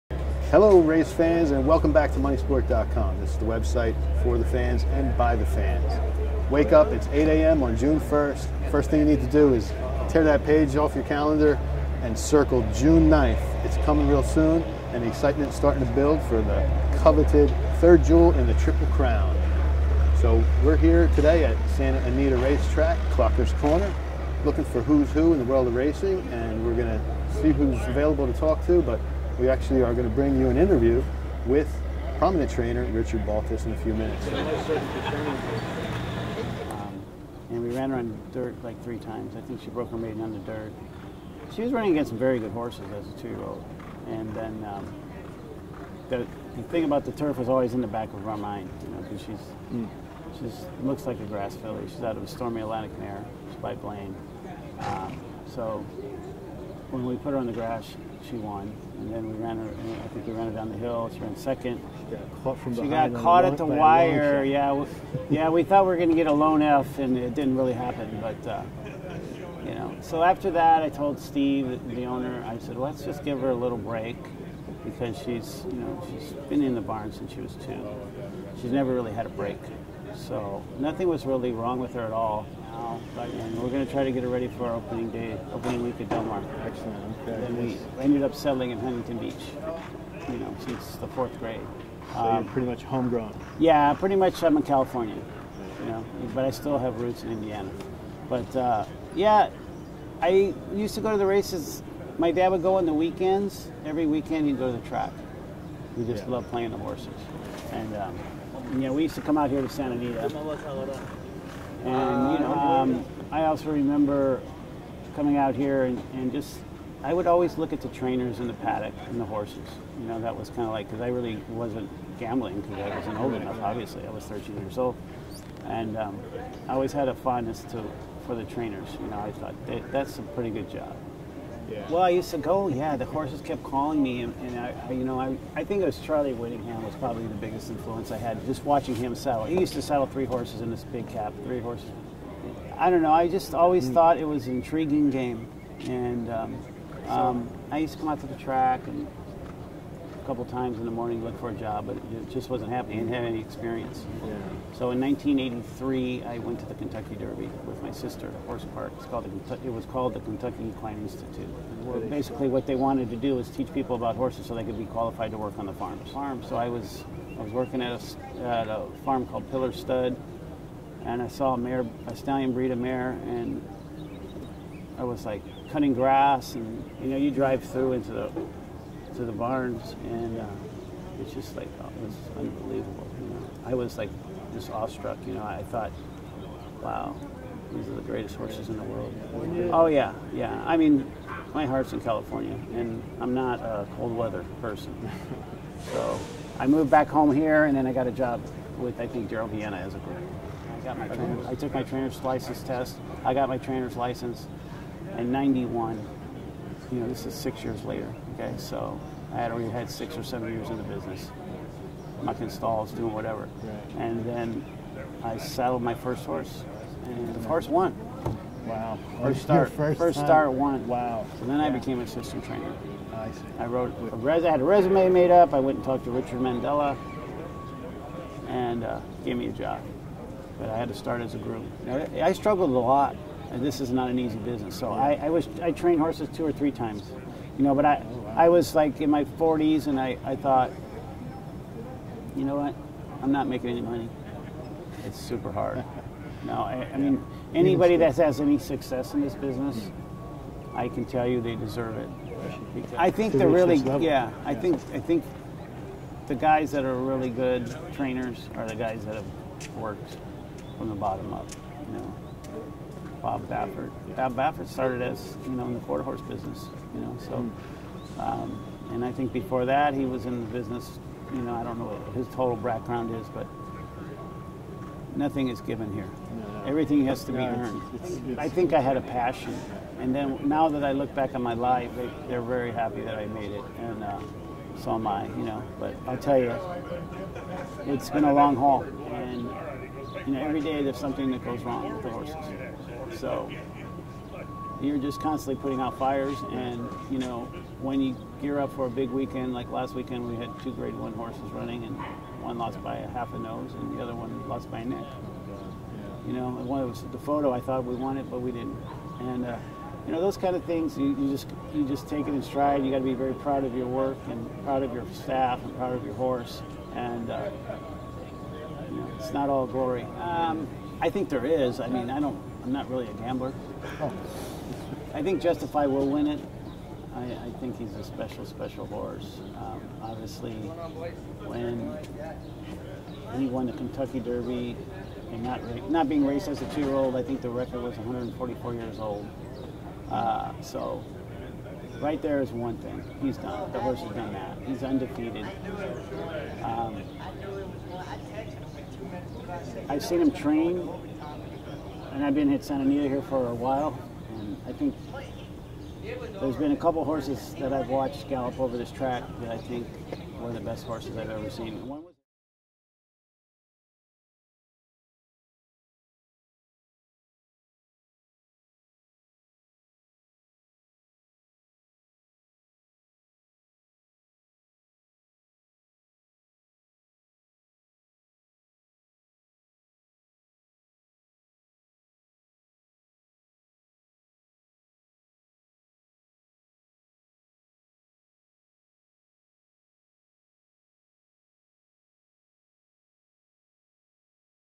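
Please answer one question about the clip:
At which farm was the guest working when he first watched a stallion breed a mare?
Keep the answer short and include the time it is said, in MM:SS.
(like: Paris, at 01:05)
Pillar Stud, at 02:49.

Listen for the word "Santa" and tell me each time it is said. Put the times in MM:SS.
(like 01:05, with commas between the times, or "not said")
00:21, 01:49, 05:52.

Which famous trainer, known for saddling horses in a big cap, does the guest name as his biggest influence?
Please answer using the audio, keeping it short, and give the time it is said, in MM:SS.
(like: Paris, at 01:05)
Charlie Whittingham, at 02:15.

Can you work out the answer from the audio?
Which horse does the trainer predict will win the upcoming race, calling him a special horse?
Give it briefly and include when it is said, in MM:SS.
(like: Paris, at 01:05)
Justify, at 05:25.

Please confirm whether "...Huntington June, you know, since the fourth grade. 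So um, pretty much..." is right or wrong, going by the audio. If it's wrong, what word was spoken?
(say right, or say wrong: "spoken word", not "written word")
wrong: "Beach", not "June".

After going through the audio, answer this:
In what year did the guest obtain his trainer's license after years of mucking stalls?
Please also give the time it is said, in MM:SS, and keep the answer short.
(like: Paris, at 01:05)
1991, at 03:25.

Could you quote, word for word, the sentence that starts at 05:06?
You know, and one was the photo.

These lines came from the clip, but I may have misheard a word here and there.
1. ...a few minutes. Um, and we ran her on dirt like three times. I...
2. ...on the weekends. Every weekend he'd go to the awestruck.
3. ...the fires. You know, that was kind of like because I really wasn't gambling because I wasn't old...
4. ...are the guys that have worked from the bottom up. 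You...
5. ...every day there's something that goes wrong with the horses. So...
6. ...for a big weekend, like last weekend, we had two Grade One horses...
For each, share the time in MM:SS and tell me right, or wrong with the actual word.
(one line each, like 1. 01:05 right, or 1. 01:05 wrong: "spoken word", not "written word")
1. 00:33 right
2. 01:42 wrong: "track", not "awestruck"
3. 01:59 wrong: "horses", not "fires"
4. 04:18 right
5. 04:50 right
6. 04:58 right.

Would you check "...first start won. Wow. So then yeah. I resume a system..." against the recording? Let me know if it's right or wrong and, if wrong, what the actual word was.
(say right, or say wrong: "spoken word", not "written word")
wrong: "became", not "resume".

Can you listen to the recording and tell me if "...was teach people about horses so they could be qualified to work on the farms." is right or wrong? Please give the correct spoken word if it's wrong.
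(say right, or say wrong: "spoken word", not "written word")
right.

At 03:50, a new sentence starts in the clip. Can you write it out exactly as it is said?
But I had to start as a groom.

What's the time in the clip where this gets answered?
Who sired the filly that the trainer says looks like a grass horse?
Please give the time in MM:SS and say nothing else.
00:53.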